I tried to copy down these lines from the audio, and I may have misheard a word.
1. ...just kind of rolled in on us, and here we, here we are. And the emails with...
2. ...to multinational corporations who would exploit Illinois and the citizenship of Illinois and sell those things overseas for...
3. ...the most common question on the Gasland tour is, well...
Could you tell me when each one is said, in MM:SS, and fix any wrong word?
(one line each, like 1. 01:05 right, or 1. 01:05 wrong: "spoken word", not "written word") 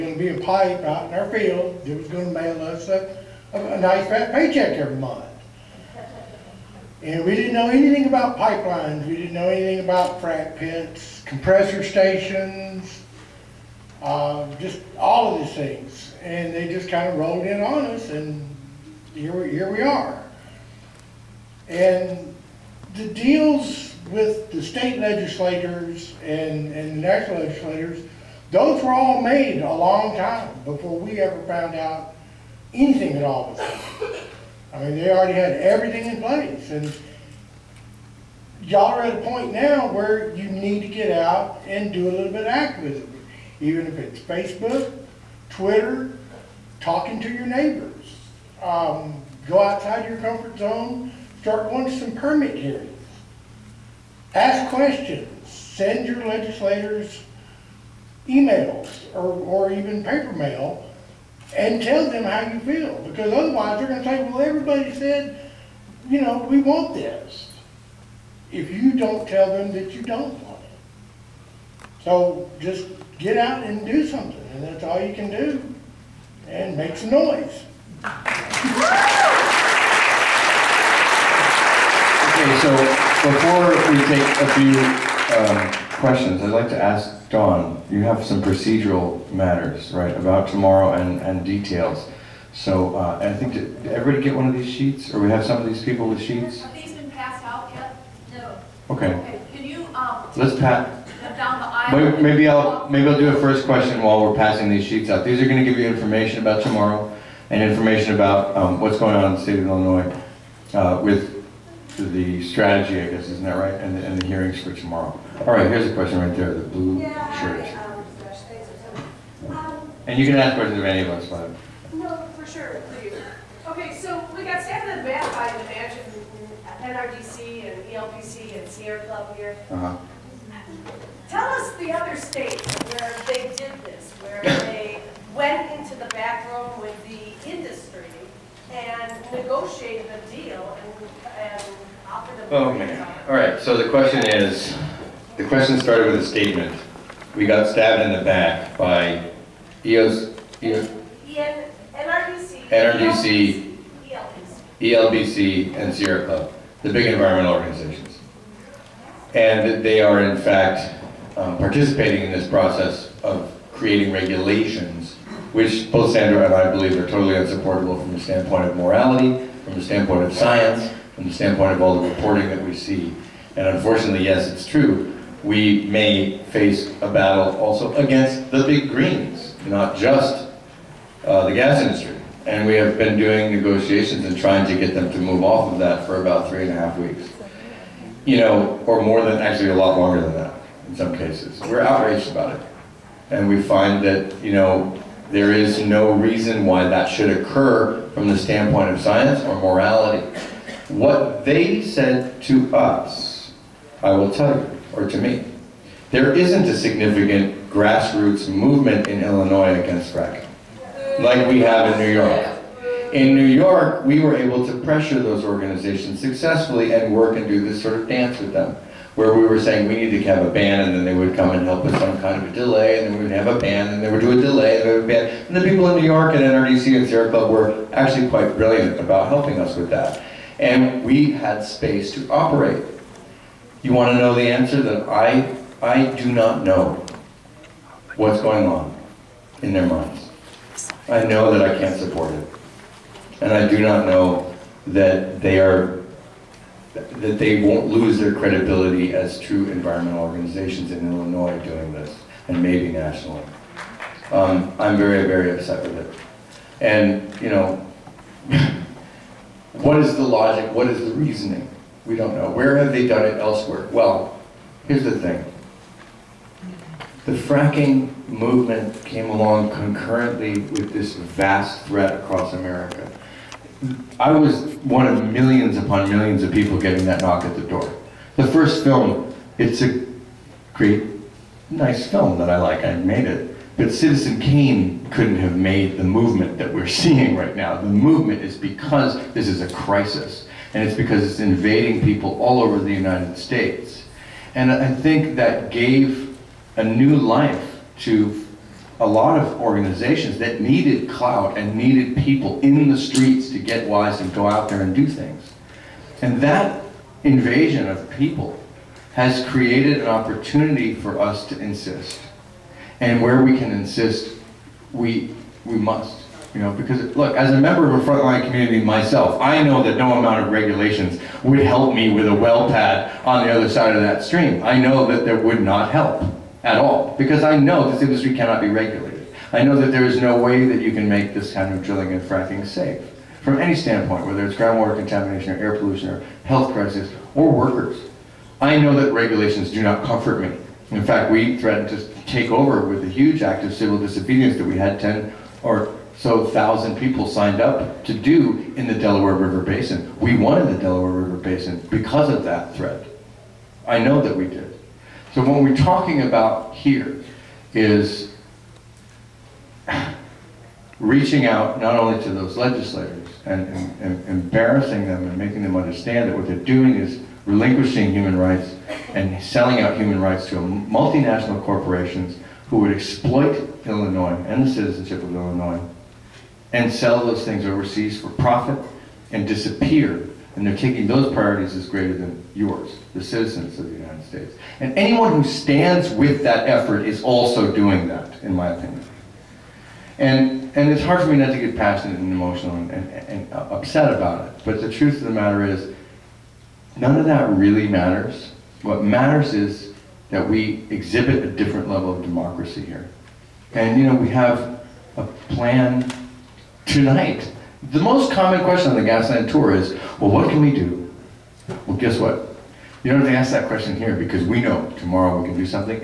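1. 00:16 wrong: "deals", not "emails"
2. 06:10 right
3. 06:47 right.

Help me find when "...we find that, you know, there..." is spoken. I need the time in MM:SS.
03:13.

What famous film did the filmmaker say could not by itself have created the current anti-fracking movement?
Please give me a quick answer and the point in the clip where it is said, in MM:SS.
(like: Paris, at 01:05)
Citizen Kane, at 04:43.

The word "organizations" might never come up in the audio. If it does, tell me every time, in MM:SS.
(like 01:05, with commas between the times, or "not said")
02:37, 03:35, 04:10, 04:59.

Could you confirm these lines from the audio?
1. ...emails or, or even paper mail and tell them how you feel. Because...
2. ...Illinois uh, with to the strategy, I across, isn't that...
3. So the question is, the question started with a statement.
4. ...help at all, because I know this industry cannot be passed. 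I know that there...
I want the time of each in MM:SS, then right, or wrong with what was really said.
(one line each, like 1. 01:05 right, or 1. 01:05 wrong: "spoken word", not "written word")
1. 00:58 right
2. 01:49 wrong: "guess", not "across"
3. 02:23 right
4. 05:25 wrong: "regulated", not "passed".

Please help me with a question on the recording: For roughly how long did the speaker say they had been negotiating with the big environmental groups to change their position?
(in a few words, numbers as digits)
three and a half weeks.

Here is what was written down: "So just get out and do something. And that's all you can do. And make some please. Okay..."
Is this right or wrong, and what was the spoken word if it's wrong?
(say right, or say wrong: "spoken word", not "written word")
wrong: "noise", not "please".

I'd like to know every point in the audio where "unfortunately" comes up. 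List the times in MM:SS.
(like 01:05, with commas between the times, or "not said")
02:53.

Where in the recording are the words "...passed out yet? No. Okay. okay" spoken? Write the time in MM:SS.
01:37.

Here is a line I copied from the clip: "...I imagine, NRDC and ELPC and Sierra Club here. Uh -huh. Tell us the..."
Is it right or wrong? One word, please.
right.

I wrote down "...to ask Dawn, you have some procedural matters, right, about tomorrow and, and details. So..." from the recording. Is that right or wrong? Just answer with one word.
right.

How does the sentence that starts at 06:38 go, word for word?
What matters is that we exhibit a different level of democracy here.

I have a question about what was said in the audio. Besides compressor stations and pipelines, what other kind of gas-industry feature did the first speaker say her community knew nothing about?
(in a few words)
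frac pits.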